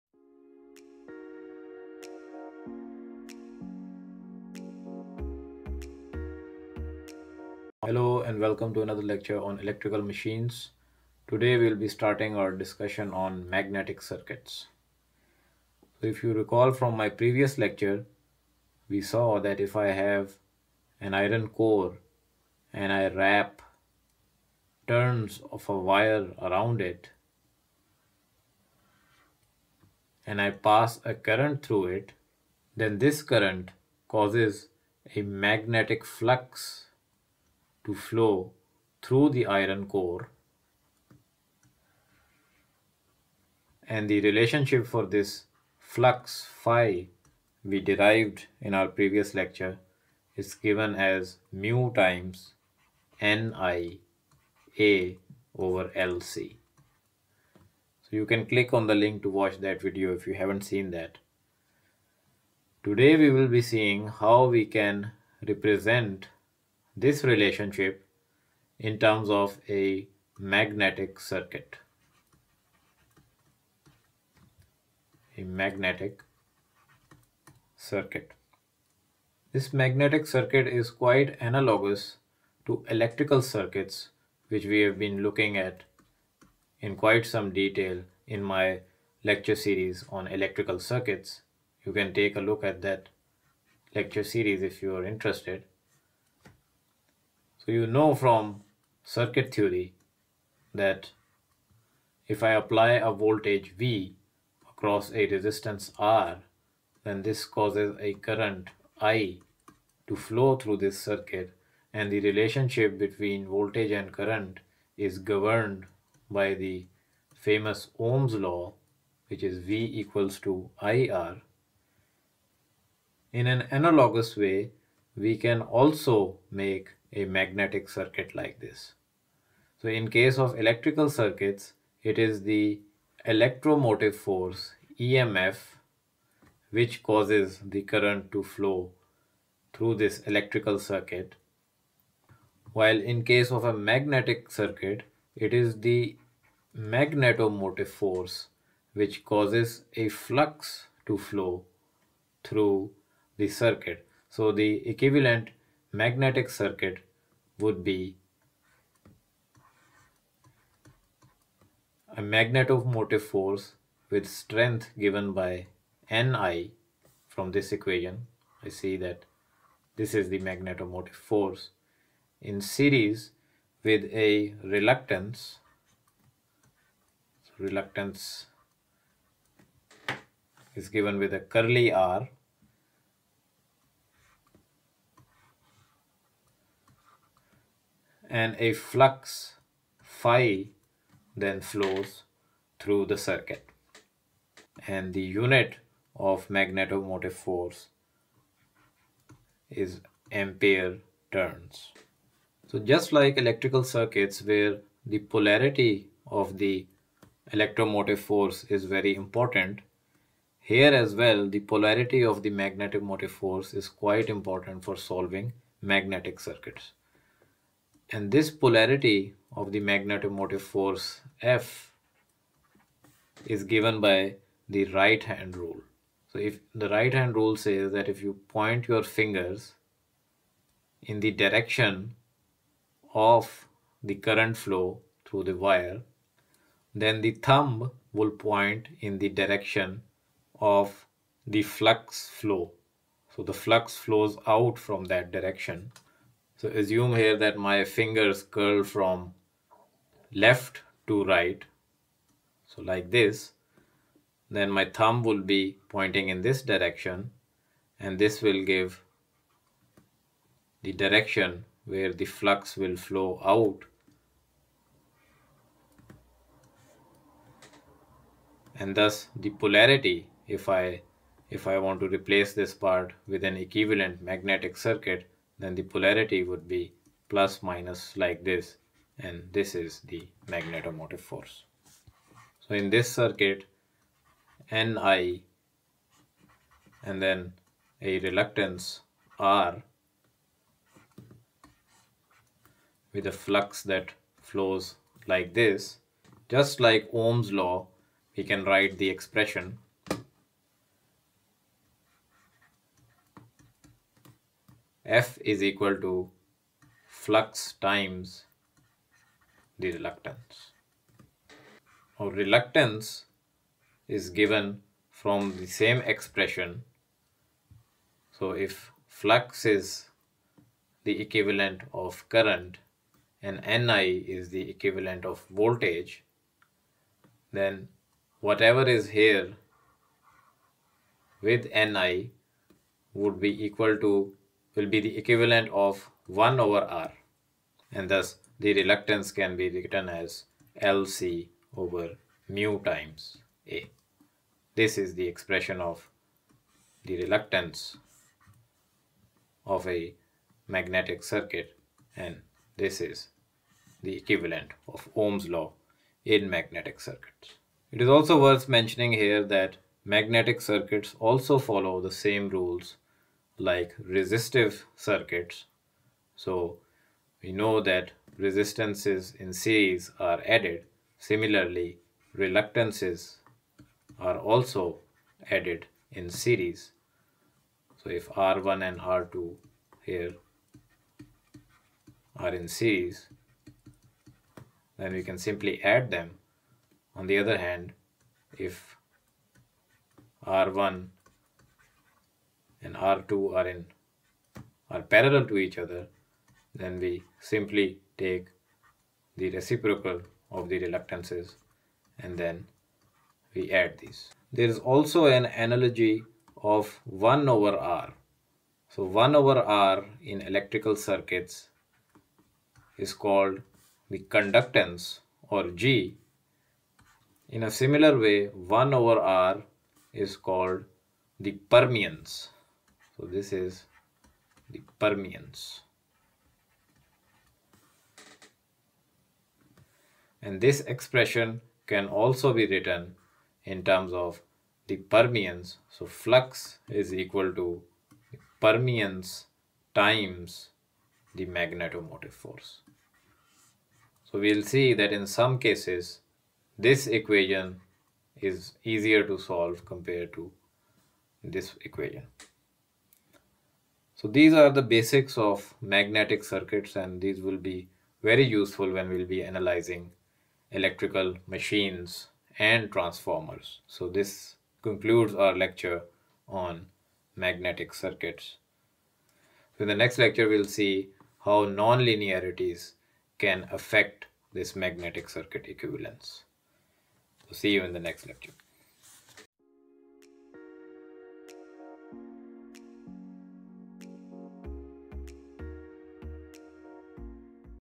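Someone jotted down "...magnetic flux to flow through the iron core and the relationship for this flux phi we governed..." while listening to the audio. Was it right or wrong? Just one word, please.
wrong.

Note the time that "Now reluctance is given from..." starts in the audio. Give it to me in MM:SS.
05:12.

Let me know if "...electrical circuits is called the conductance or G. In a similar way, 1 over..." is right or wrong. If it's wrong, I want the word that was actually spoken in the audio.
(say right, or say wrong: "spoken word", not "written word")
right.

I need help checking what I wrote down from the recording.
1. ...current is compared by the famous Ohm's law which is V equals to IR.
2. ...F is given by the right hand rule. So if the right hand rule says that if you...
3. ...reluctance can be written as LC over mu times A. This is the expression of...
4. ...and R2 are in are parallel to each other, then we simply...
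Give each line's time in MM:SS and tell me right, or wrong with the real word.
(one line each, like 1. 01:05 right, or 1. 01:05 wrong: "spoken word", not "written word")
1. 01:54 wrong: "governed", not "compared"
2. 03:41 right
3. 05:38 right
4. 06:32 right.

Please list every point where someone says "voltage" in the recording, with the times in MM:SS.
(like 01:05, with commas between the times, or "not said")
01:43, 01:53, 05:25.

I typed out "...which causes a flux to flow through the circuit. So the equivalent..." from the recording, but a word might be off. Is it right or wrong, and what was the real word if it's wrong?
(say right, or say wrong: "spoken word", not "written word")
right.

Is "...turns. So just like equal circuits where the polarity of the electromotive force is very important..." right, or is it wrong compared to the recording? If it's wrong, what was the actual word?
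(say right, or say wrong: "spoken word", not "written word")
wrong: "electrical", not "equal".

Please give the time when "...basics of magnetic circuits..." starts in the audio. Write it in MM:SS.
07:34.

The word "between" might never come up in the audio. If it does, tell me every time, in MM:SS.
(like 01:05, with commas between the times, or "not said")
01:52.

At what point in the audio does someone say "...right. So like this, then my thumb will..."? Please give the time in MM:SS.
04:11.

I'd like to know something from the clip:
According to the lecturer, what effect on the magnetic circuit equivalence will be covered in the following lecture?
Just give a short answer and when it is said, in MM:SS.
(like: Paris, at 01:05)
Non-linearities, at 07:51.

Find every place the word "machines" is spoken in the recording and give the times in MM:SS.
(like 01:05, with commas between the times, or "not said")
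00:10, 07:41.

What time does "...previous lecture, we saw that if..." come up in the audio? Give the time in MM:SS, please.
00:17.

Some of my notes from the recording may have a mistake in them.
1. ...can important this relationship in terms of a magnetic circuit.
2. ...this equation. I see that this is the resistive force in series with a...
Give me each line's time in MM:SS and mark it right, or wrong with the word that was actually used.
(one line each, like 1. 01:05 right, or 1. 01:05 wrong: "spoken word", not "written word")
1. 01:04 wrong: "represent", not "important"
2. 02:47 wrong: "magnetomotive", not "resistive".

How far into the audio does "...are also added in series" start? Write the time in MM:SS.
06:14.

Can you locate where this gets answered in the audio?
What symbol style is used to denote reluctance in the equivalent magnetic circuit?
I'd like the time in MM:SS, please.
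03:01.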